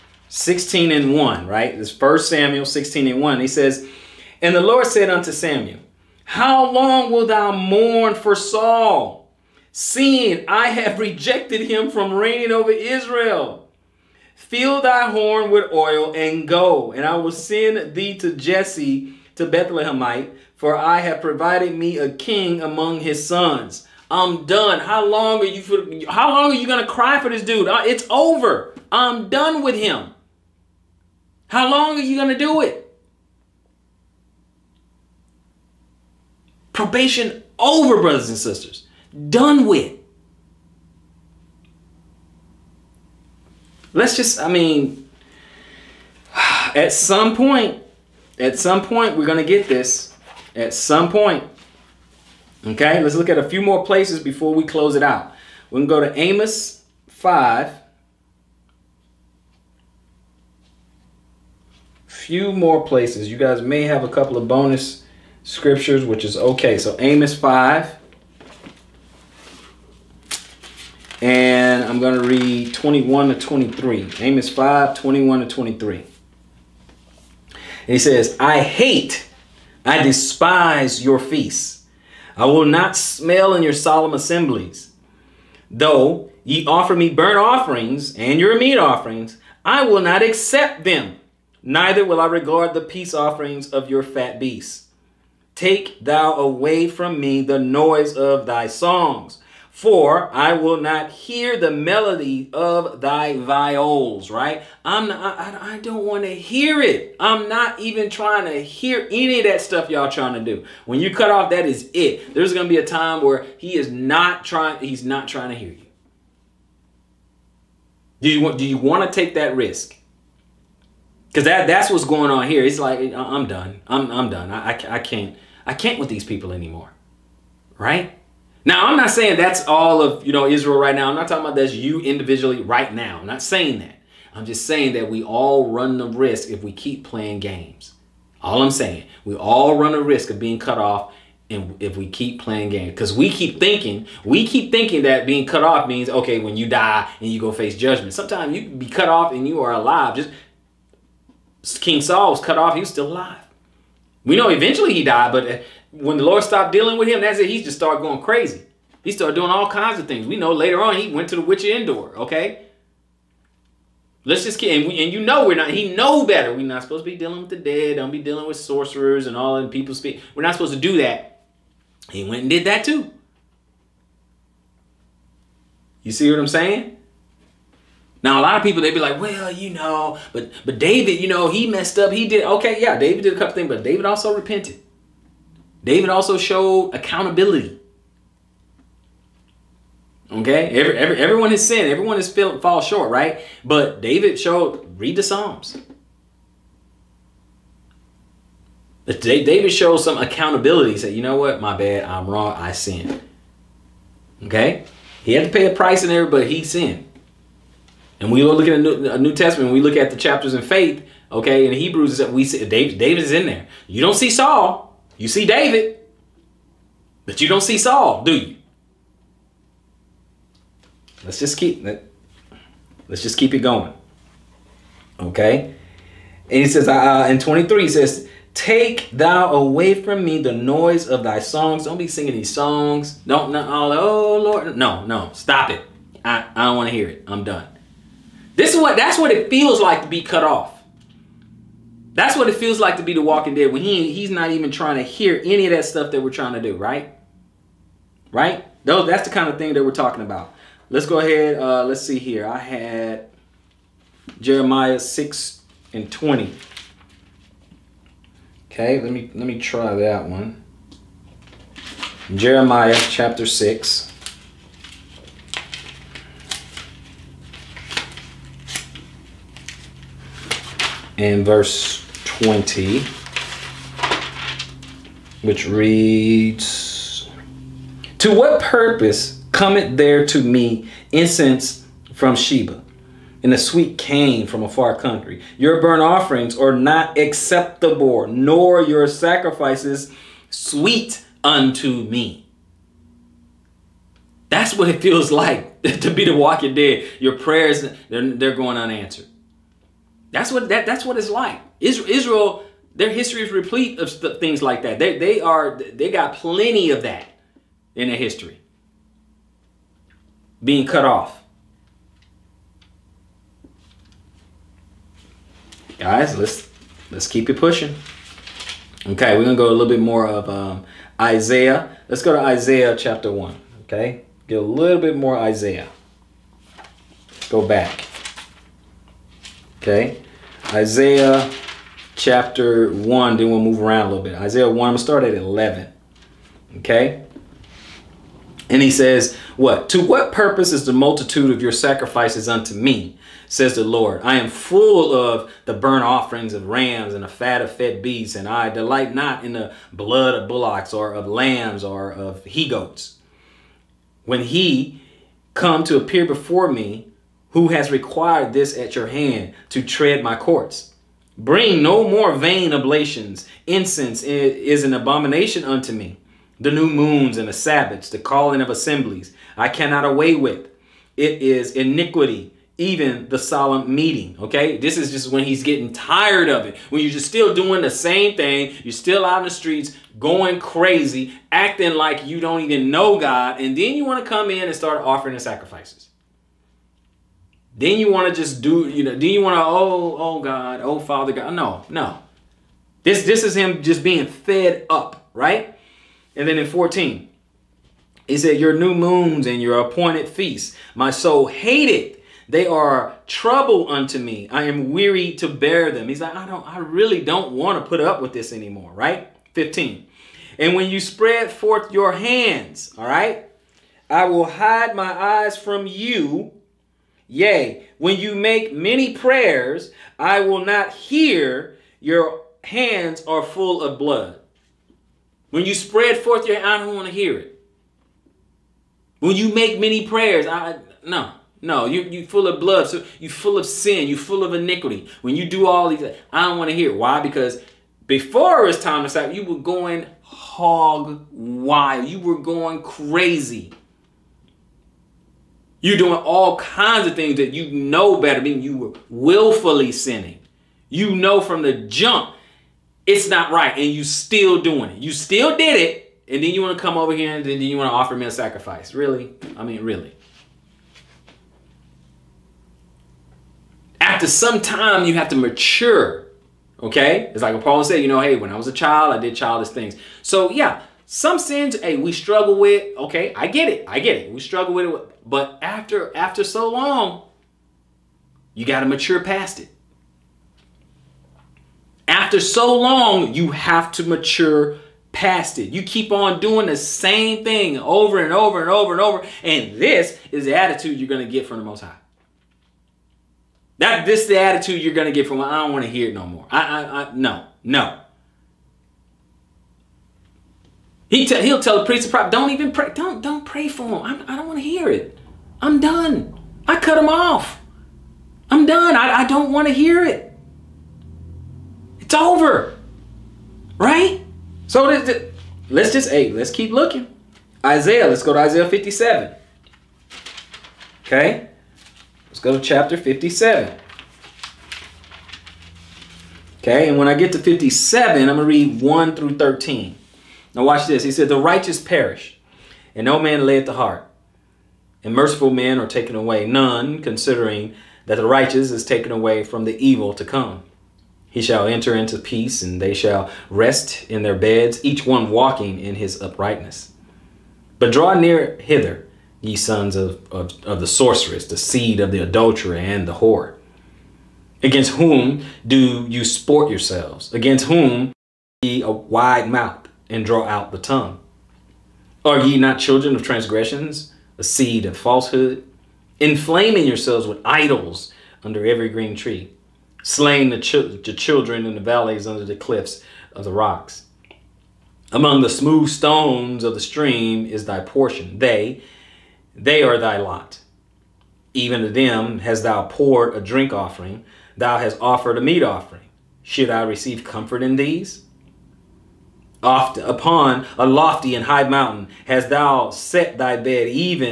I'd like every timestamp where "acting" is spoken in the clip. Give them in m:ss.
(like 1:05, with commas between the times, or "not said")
6:21.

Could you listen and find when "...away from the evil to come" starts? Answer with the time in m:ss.
8:59.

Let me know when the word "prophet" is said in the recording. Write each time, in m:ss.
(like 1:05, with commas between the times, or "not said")
8:22.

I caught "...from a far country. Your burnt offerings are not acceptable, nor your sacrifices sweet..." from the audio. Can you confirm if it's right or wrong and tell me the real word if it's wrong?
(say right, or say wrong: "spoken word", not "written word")
right.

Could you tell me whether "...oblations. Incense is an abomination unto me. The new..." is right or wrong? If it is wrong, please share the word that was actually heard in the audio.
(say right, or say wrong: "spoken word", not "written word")
right.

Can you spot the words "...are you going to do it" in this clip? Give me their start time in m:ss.
0:31.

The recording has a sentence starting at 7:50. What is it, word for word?
So yeah, some sins, hey, we struggle with.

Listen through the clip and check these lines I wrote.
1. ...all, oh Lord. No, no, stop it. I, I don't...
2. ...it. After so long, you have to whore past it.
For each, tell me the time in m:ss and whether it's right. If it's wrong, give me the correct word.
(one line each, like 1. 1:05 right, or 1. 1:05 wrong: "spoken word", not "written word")
1. 3:53 right
2. 7:59 wrong: "mature", not "whore".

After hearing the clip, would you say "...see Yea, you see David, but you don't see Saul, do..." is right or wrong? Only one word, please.
wrong.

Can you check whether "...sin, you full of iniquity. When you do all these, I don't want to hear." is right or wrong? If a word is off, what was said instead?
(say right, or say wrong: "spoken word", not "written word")
right.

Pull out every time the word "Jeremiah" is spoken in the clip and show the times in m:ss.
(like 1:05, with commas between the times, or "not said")
4:14, 4:22.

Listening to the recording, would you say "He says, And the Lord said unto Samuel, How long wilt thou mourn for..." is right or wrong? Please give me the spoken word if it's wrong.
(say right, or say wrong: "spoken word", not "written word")
right.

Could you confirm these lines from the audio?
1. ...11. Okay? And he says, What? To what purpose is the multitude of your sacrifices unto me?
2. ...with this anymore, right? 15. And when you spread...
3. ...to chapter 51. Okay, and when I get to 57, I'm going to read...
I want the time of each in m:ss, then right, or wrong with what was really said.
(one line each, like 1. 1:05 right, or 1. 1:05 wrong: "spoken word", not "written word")
1. 5:35 right
2. 6:48 right
3. 8:42 wrong: "57", not "51".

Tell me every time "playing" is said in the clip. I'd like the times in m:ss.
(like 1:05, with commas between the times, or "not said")
2:17, 2:22.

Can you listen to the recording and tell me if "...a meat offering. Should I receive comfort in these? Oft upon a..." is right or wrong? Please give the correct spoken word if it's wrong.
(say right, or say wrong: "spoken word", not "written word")
right.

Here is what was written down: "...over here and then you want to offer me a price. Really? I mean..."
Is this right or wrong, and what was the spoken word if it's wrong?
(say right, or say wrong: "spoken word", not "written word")
wrong: "sacrifice", not "price".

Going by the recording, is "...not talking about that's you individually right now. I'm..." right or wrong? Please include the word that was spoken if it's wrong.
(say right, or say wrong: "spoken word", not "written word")
right.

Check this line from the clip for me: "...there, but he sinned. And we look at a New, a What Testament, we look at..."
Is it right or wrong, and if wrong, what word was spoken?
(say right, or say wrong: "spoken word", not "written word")
wrong: "New", not "What".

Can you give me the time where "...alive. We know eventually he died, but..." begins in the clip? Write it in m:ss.
2:33.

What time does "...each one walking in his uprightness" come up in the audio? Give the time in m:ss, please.
9:04.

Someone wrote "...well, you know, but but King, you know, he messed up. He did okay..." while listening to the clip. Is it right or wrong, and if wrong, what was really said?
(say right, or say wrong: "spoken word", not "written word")
wrong: "David", not "King".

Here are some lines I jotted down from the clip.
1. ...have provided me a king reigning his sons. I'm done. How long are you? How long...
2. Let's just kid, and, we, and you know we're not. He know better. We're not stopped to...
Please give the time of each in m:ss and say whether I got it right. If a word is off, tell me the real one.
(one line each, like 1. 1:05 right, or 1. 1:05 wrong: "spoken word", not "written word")
1. 0:21 wrong: "among", not "reigning"
2. 2:44 wrong: "supposed", not "stopped".